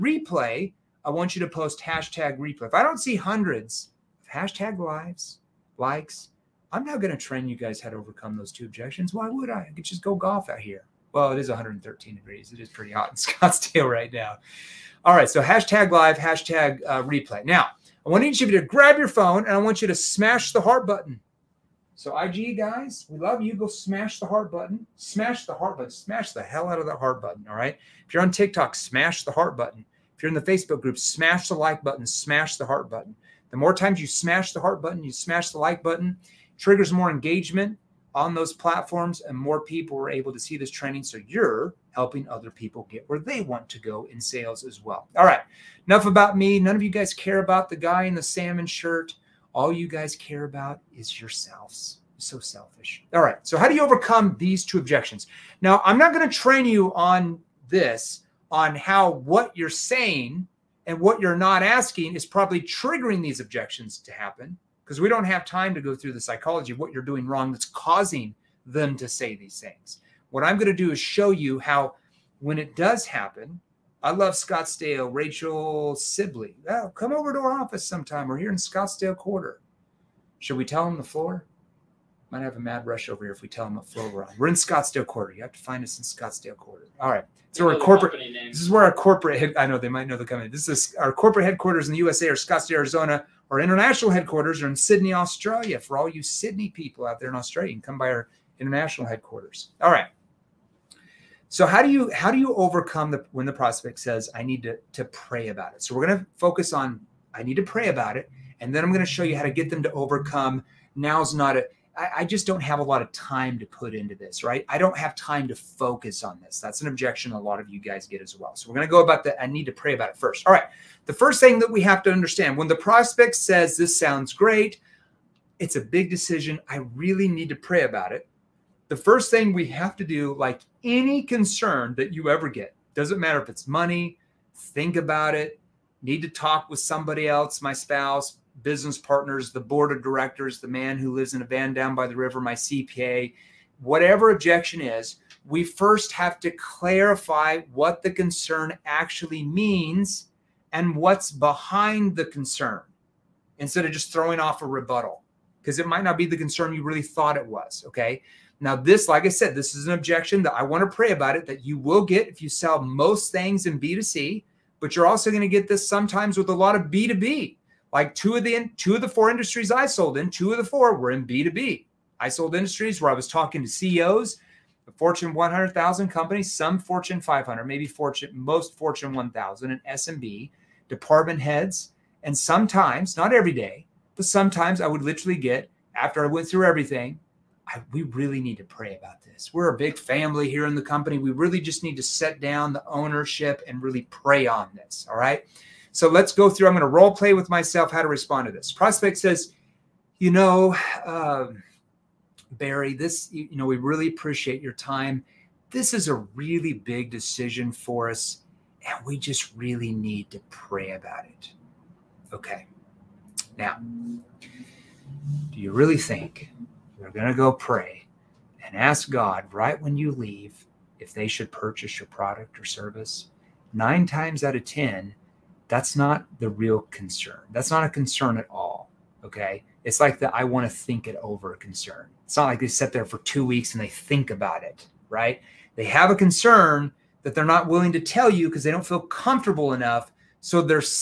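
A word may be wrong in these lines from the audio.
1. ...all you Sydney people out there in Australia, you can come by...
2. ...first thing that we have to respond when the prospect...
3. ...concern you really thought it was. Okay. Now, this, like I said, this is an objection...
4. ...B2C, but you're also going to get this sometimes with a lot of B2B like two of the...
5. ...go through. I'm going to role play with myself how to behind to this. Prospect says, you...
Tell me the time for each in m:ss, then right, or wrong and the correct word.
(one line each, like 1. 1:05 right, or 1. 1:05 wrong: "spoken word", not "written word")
1. 1:35 right
2. 2:01 wrong: "understand", not "respond"
3. 2:36 right
4. 2:43 right
5. 3:16 wrong: "respond", not "behind".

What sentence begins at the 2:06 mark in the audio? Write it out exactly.
I really need to pray about it.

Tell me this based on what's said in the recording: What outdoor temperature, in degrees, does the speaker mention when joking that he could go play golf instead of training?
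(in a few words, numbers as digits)
113.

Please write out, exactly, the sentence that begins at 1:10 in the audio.
What I'm going to do is show you how, when it does happen, I love Scottsdale, Rachel Sibley.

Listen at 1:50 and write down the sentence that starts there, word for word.
Now's not a I, I just don't have a lot of time to put into this, right?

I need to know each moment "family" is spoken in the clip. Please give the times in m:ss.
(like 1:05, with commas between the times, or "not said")
3:09.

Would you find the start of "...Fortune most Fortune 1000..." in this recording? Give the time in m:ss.
2:57.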